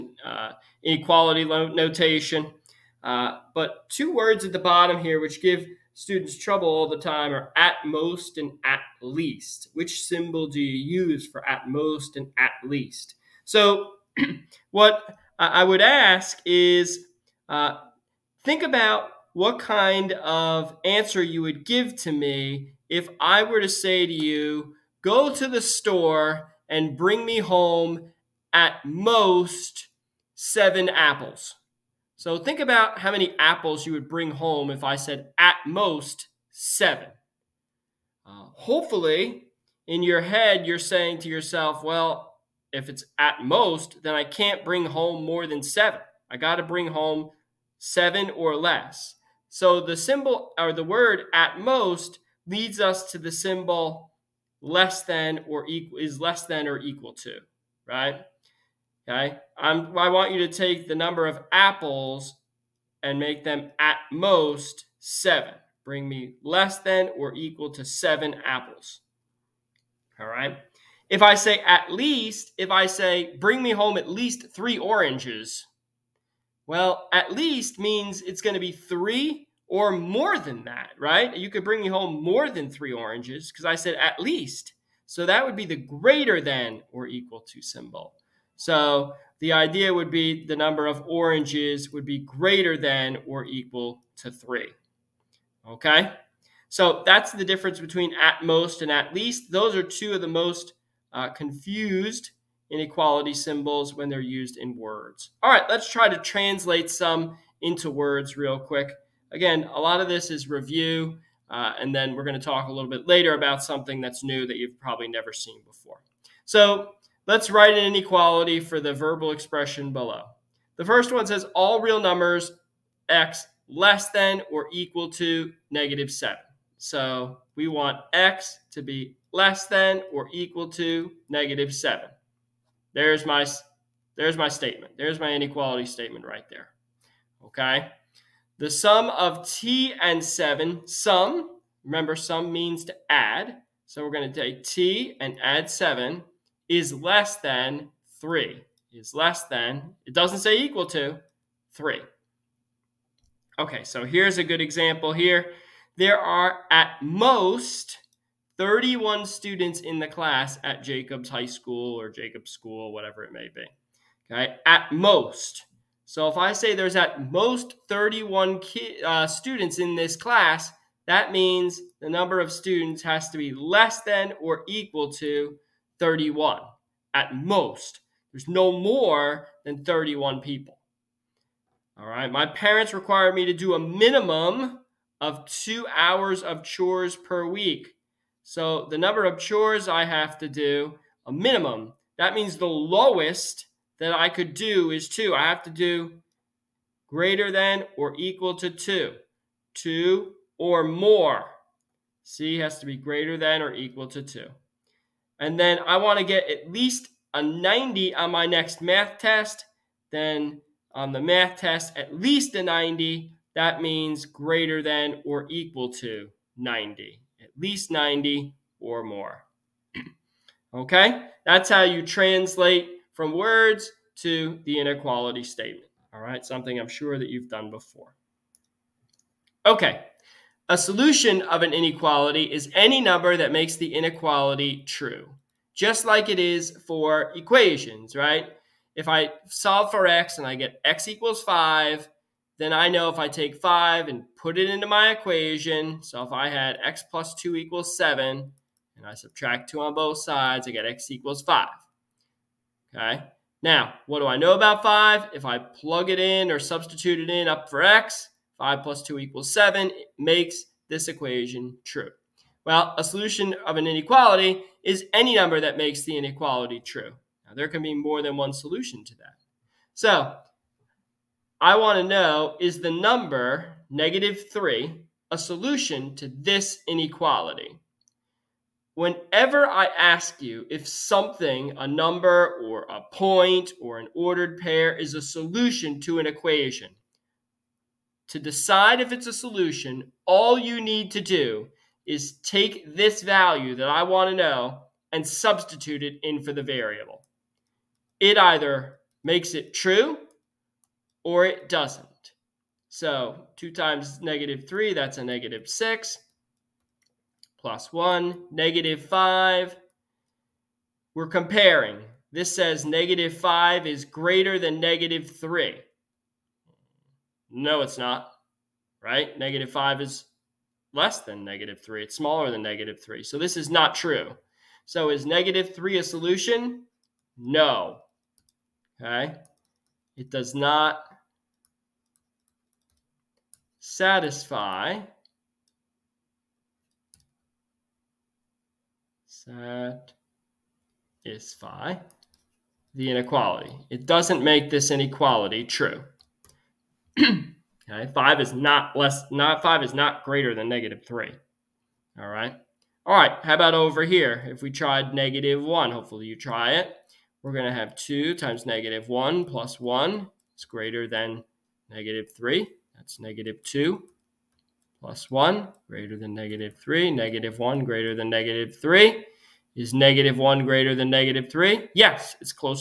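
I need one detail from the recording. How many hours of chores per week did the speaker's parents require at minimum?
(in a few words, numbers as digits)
2.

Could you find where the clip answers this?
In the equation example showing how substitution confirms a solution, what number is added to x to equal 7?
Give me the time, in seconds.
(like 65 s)
246 s.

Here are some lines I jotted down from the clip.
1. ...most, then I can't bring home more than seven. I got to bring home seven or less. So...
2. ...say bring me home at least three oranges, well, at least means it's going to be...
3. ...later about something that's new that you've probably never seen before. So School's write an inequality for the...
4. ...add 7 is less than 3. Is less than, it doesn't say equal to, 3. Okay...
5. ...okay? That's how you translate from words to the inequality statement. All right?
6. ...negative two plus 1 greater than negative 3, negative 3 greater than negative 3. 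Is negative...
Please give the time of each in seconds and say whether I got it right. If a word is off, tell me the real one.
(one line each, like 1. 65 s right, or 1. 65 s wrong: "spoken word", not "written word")
1. 43 s right
2. 72 s right
3. 113 s wrong: "Let", not "School"
4. 145 s right
5. 220 s right
6. 363 s wrong: "1", not "3".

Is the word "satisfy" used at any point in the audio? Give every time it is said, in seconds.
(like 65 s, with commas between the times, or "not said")
333 s, 339 s.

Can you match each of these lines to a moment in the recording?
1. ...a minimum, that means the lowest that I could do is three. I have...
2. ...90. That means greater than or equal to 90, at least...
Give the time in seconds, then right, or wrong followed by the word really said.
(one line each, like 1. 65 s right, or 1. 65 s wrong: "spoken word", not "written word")
1. 191 s wrong: "two", not "three"
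2. 212 s right.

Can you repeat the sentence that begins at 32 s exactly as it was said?
So think about how many apples you would bring home if I said at most seven.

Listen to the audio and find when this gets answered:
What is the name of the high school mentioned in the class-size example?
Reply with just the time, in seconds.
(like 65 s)
160 s.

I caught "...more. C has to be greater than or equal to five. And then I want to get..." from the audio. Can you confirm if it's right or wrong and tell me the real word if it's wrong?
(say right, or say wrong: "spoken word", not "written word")
wrong: "two", not "five".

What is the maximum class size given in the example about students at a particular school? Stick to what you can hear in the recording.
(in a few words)
31.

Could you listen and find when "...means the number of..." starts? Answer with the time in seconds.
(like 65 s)
171 s.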